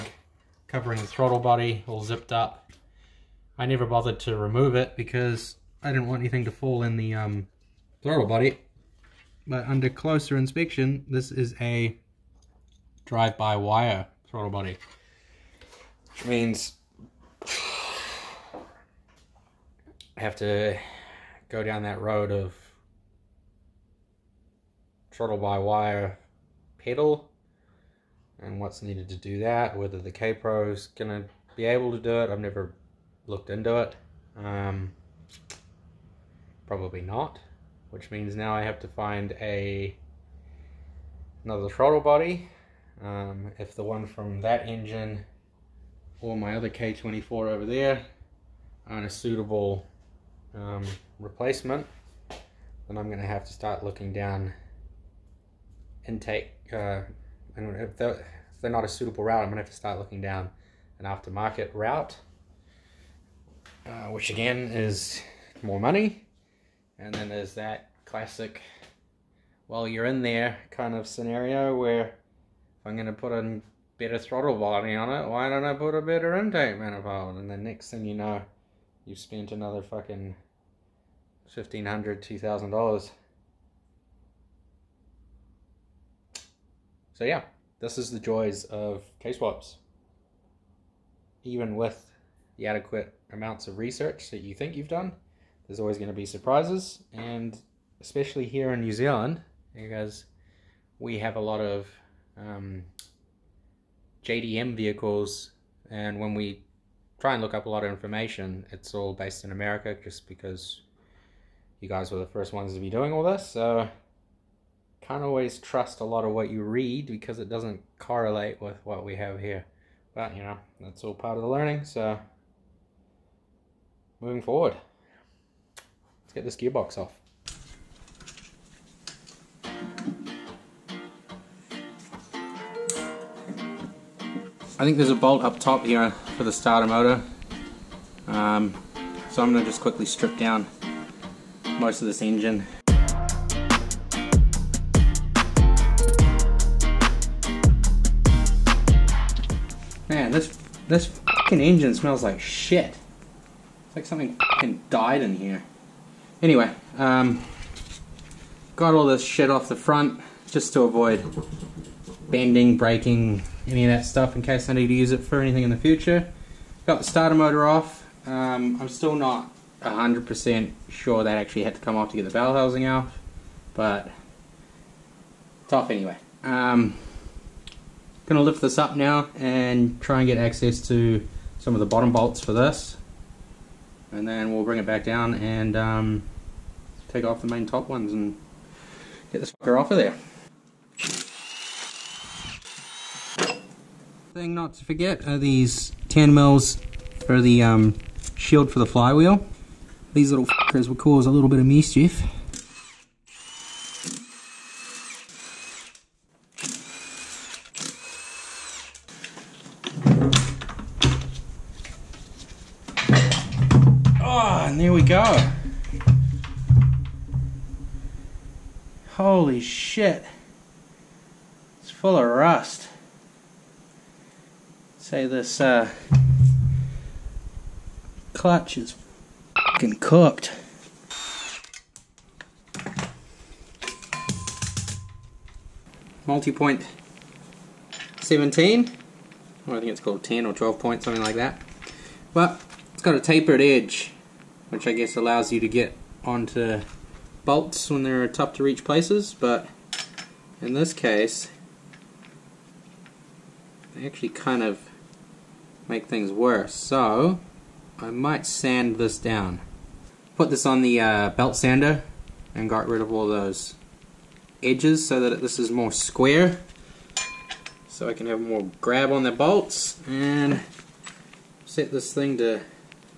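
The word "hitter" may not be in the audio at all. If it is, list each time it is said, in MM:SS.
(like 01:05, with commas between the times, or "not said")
not said.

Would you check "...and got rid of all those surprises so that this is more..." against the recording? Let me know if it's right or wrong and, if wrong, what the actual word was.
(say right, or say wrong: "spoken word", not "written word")
wrong: "edges", not "surprises".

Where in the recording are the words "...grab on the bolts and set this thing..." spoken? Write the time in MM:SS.
04:28.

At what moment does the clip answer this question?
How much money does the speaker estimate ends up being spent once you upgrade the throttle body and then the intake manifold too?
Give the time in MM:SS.
01:21.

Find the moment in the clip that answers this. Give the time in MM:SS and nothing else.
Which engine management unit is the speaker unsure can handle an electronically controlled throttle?
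00:30.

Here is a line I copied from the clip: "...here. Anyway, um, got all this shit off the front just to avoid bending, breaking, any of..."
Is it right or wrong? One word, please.
right.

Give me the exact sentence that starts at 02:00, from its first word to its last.
But, you know, that's all part of the learning, so moving forward get this gearbox off.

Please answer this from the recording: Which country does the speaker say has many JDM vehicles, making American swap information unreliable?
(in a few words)
New Zealand.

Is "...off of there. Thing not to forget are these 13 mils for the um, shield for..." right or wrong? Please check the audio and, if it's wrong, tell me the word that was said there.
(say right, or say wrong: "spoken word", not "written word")
wrong: "10", not "13".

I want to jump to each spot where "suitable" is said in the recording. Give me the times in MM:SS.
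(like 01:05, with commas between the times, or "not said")
00:49, 00:58.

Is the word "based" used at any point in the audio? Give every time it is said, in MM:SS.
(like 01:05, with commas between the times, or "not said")
01:49.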